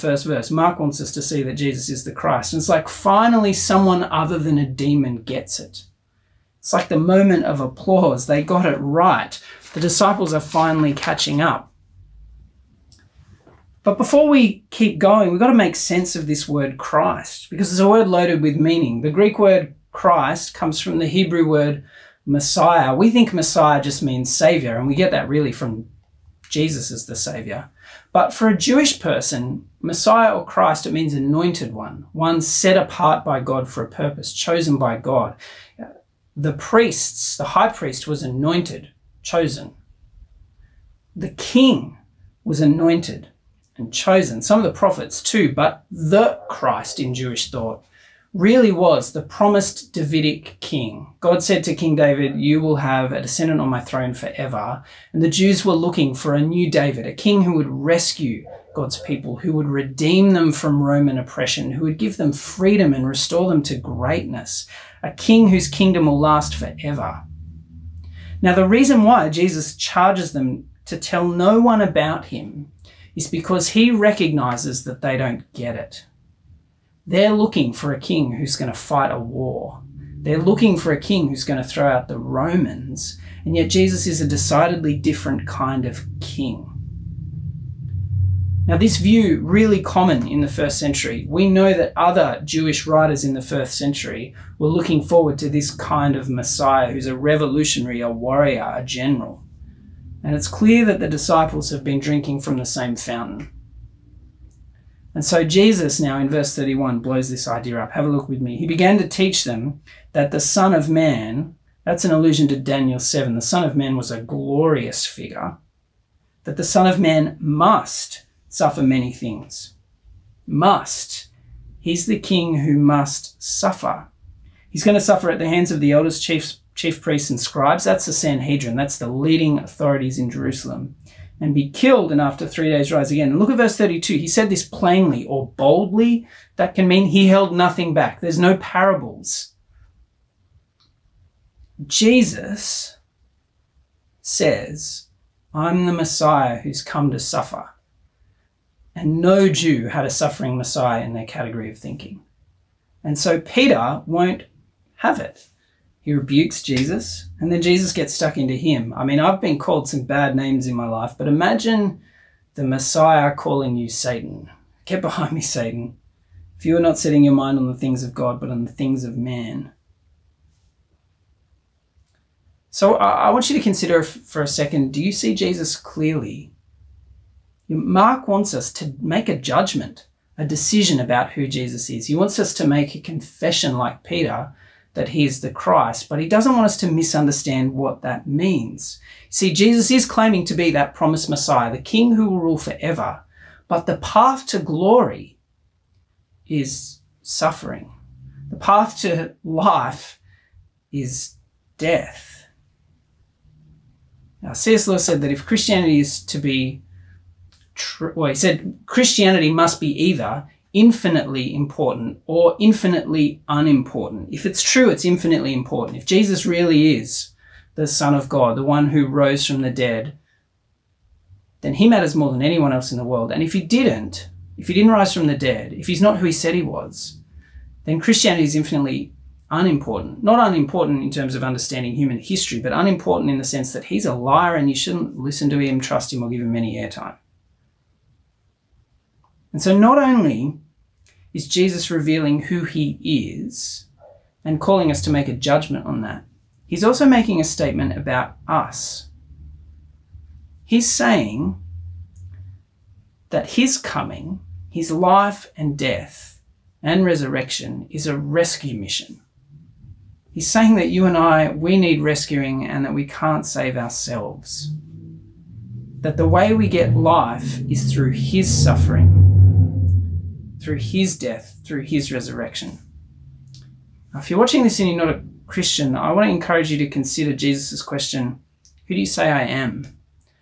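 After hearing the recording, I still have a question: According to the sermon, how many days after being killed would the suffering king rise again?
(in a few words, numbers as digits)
3.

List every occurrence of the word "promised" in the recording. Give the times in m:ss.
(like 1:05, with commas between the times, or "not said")
0:49, 3:10.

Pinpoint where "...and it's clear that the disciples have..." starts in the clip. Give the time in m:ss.
1:40.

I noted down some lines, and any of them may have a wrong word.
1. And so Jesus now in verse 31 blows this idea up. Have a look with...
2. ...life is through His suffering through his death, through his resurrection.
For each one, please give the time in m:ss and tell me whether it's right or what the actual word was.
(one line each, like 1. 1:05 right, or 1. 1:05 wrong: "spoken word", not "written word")
1. 1:45 right
2. 4:26 right.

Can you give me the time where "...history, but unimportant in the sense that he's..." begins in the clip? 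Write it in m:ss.
3:52.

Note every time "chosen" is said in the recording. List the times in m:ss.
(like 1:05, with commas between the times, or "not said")
0:34, 0:39, 0:43.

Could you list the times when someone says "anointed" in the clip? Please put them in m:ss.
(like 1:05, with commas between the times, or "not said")
0:31, 0:38, 0:42.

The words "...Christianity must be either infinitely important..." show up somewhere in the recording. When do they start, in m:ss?
3:28.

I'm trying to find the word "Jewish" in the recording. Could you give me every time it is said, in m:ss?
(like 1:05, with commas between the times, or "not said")
0:28, 0:47, 1:32.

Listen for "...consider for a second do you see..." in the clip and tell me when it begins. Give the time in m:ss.
2:53.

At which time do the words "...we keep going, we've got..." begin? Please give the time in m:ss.
0:14.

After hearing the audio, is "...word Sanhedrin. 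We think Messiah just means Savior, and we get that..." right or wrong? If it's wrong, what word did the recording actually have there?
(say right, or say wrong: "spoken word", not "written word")
wrong: "Messiah", not "Sanhedrin".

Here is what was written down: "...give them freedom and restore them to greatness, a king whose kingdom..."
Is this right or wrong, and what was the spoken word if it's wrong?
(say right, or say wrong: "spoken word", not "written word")
right.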